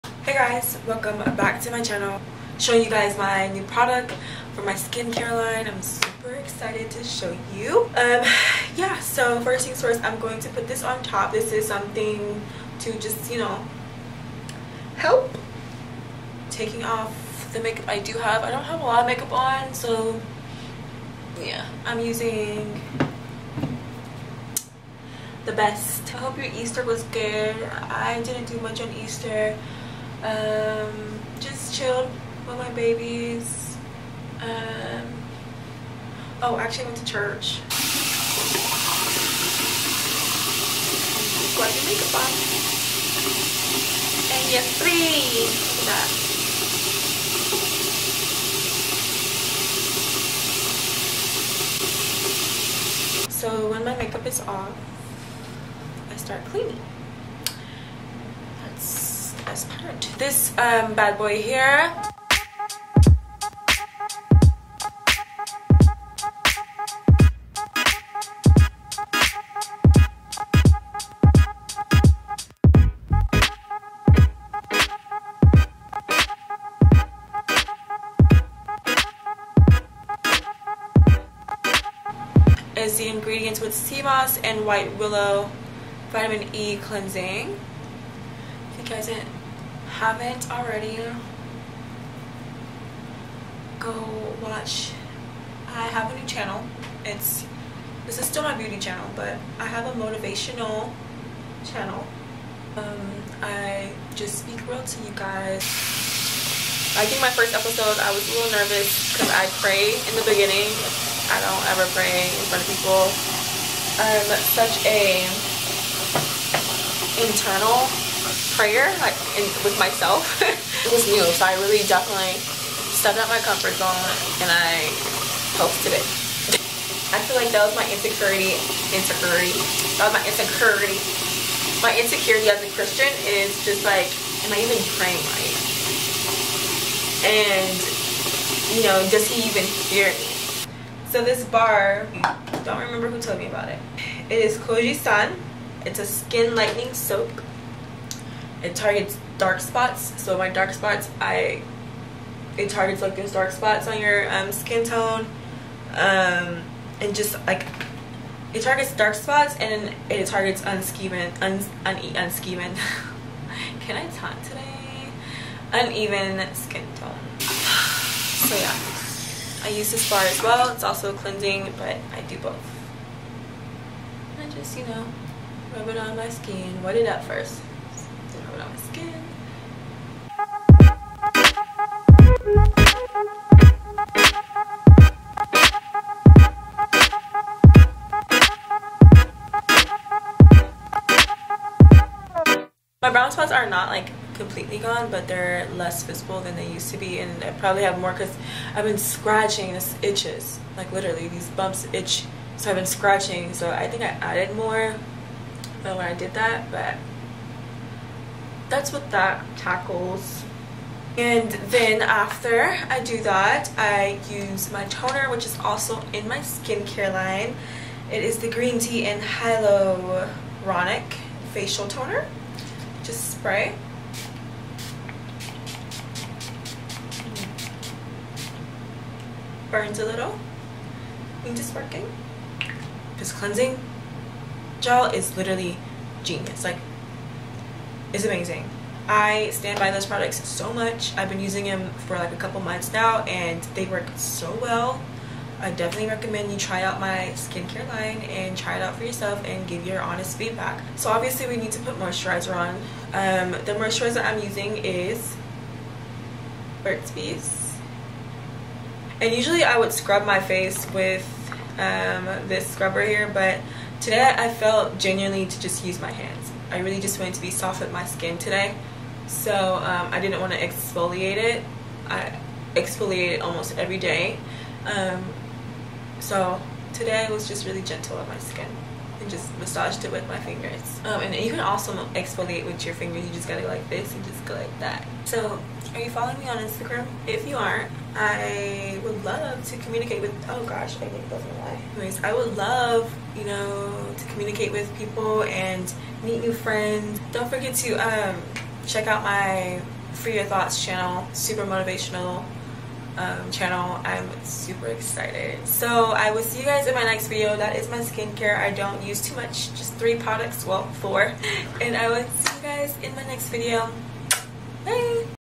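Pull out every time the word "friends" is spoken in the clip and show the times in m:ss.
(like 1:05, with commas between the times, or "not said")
4:56.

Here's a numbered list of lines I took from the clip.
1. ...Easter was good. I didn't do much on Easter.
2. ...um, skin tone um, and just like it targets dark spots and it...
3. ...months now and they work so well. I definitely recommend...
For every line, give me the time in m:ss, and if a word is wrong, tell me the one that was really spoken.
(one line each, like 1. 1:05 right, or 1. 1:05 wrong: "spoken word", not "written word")
1. 0:26 right
2. 2:34 right
3. 4:02 right.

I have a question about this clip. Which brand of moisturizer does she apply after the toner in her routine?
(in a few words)
Burt's Bees.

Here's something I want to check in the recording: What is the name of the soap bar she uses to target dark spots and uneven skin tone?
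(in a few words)
Kojie San.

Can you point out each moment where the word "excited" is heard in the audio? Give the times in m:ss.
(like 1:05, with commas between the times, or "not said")
0:06, 5:04.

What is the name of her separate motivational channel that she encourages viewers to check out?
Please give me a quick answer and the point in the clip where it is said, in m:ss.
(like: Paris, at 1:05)
Free Your Thoughts, at 5:00.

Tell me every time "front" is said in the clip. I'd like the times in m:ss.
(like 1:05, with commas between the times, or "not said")
1:52.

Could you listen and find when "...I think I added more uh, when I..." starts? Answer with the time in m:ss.
3:23.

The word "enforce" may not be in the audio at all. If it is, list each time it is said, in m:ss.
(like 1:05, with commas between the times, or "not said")
not said.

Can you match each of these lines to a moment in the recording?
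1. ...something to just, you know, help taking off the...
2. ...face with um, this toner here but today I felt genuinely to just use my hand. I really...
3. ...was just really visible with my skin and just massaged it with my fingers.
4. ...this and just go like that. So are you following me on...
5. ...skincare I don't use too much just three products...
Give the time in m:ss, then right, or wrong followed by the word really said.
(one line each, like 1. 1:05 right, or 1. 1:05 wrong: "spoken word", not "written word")
1. 0:11 right
2. 4:20 wrong: "scrubber", not "toner"
3. 4:37 wrong: "gentle", not "visible"
4. 4:43 right
5. 5:07 right.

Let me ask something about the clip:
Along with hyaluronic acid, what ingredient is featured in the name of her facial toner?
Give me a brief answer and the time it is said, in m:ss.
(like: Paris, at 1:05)
Green Tea, at 3:38.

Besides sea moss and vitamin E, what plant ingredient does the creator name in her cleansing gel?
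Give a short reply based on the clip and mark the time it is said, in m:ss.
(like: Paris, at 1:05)
white willow, at 1:24.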